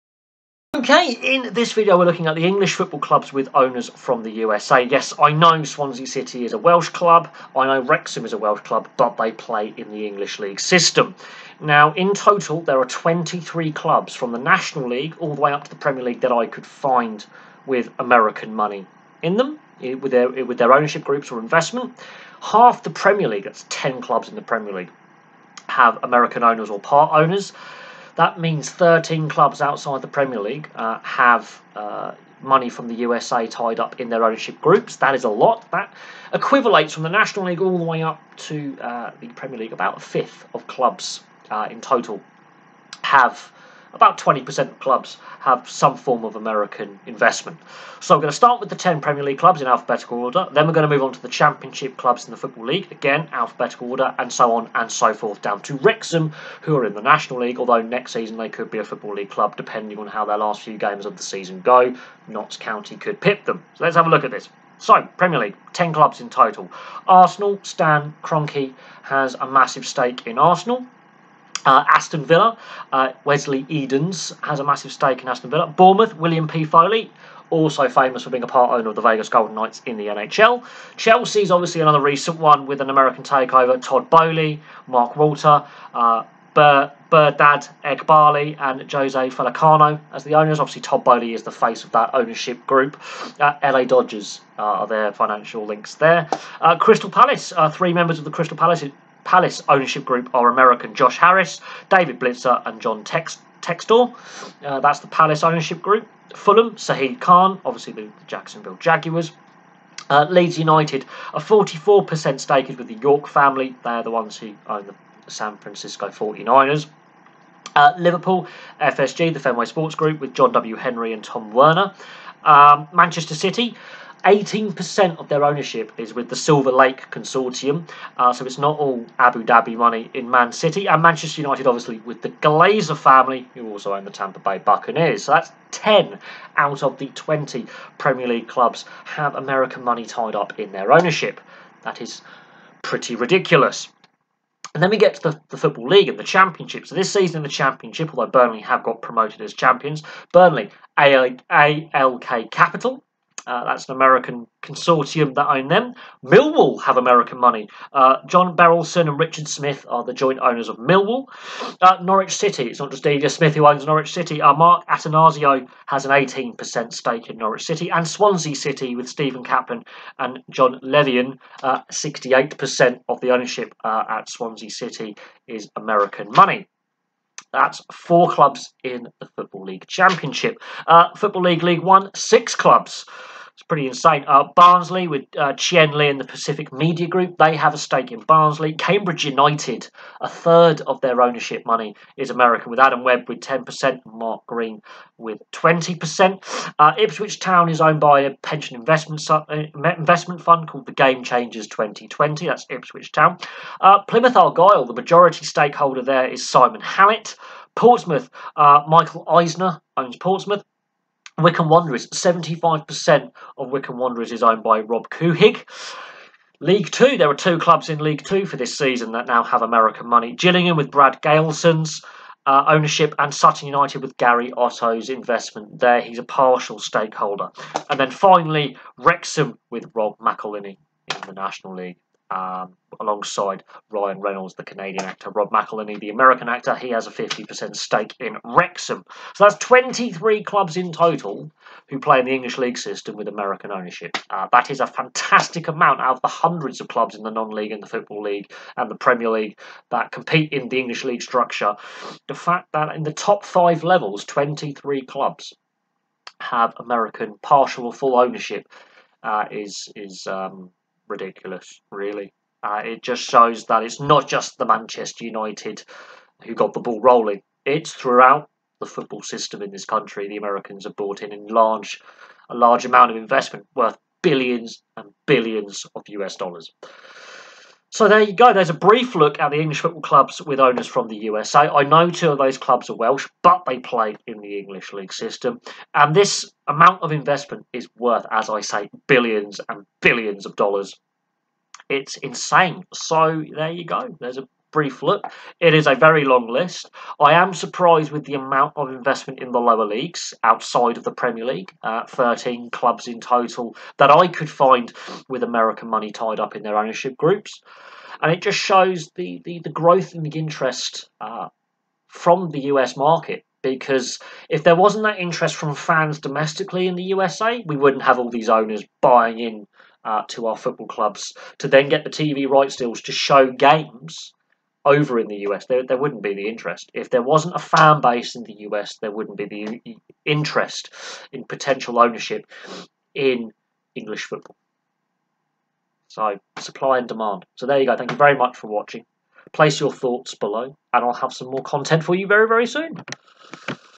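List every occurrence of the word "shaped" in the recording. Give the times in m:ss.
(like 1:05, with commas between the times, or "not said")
not said.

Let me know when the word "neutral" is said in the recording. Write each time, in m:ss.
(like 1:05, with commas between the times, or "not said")
not said.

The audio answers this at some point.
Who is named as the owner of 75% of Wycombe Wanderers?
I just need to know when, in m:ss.
3:34.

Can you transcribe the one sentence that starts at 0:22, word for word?
Half the Premier League, that's 10 clubs in the Premier League, have American owners or part owners.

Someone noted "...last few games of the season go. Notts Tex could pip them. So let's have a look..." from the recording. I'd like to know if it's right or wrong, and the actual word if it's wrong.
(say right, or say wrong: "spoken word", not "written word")
wrong: "County", not "Tex".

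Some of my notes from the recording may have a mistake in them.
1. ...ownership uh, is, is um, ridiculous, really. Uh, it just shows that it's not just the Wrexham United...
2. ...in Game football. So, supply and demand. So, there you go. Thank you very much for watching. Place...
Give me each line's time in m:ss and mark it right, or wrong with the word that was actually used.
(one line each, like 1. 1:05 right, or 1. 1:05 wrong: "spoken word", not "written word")
1. 4:18 wrong: "Manchester", not "Wrexham"
2. 5:33 wrong: "English", not "Game".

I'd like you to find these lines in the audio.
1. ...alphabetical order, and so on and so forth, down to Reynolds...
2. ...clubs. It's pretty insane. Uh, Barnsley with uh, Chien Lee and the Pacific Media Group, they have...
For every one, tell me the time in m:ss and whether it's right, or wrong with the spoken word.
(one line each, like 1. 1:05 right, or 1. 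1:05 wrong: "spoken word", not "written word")
1. 0:53 wrong: "Wrexham", not "Reynolds"
2. 3:02 right.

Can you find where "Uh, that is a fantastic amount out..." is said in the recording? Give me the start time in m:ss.
4:04.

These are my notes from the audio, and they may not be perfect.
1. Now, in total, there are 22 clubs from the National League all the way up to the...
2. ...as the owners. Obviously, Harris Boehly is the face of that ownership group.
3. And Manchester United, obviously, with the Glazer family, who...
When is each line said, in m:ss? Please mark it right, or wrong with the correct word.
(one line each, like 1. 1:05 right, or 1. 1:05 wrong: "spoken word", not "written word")
1. 0:11 wrong: "23", not "22"
2. 1:30 wrong: "Todd", not "Harris"
3. 2:10 right.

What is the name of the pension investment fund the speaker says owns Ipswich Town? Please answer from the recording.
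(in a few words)
Game Changers 2020.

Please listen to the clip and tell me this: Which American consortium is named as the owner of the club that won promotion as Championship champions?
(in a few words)
ALK Capital.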